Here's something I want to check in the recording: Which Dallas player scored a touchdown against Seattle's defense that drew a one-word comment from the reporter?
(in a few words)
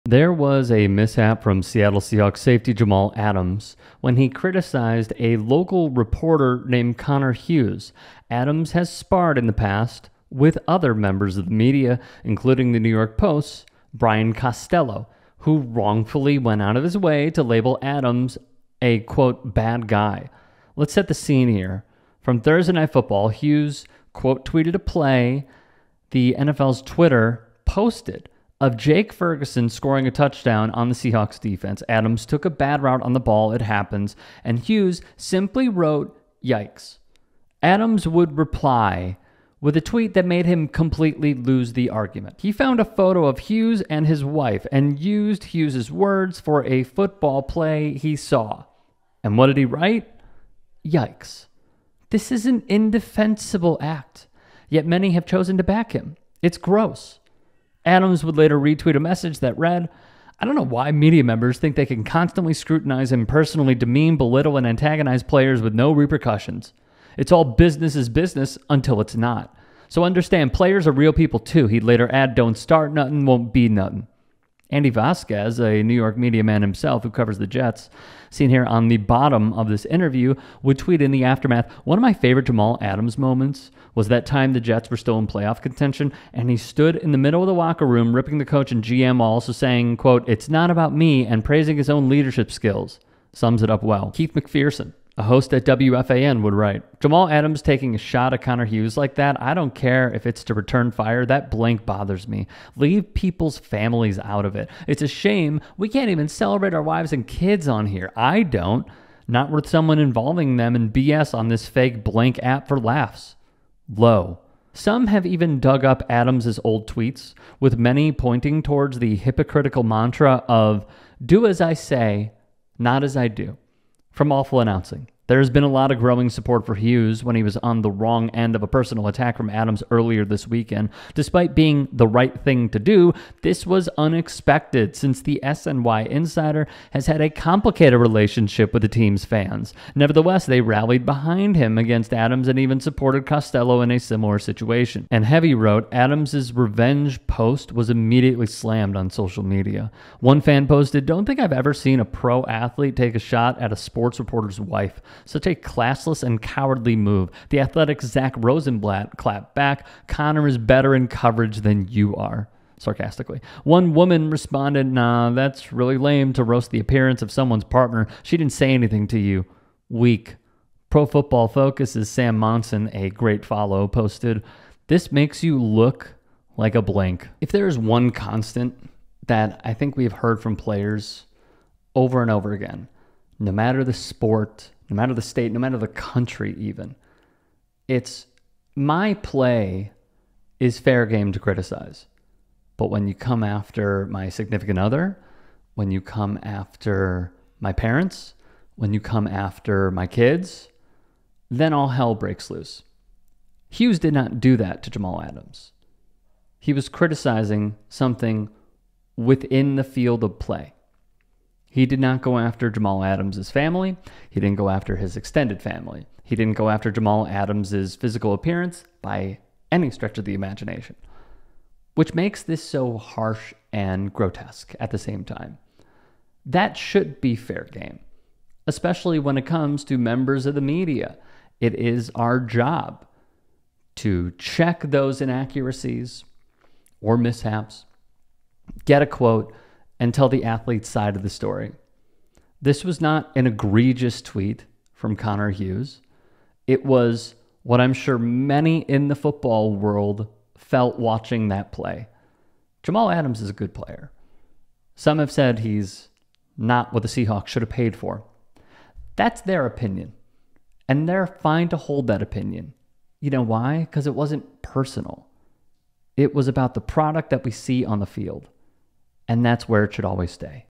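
Jake Ferguson.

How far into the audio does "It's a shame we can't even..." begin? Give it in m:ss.
1:44.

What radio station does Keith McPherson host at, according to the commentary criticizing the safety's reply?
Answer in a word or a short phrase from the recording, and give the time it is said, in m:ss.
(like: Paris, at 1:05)
WFAN, at 1:35.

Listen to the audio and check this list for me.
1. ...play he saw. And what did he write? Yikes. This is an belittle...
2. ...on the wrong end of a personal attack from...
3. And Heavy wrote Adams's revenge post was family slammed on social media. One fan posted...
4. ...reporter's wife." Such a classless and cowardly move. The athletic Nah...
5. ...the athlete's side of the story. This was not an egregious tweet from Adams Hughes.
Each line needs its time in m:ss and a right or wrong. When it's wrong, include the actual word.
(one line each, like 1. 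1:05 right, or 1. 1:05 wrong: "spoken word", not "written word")
1. 0:47 wrong: "indefensible", not "belittle"
2. 2:07 right
3. 2:25 wrong: "immediately", not "family"
4. 2:34 wrong: "Zach", not "Nah"
5. 4:00 wrong: "Connor", not "Adams".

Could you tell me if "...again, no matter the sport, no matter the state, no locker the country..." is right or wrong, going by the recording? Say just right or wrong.
wrong.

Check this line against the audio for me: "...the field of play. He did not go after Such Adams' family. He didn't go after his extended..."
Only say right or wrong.
wrong.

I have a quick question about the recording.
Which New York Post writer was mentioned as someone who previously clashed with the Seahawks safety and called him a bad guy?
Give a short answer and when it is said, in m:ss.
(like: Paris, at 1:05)
Brian Costello, at 0:13.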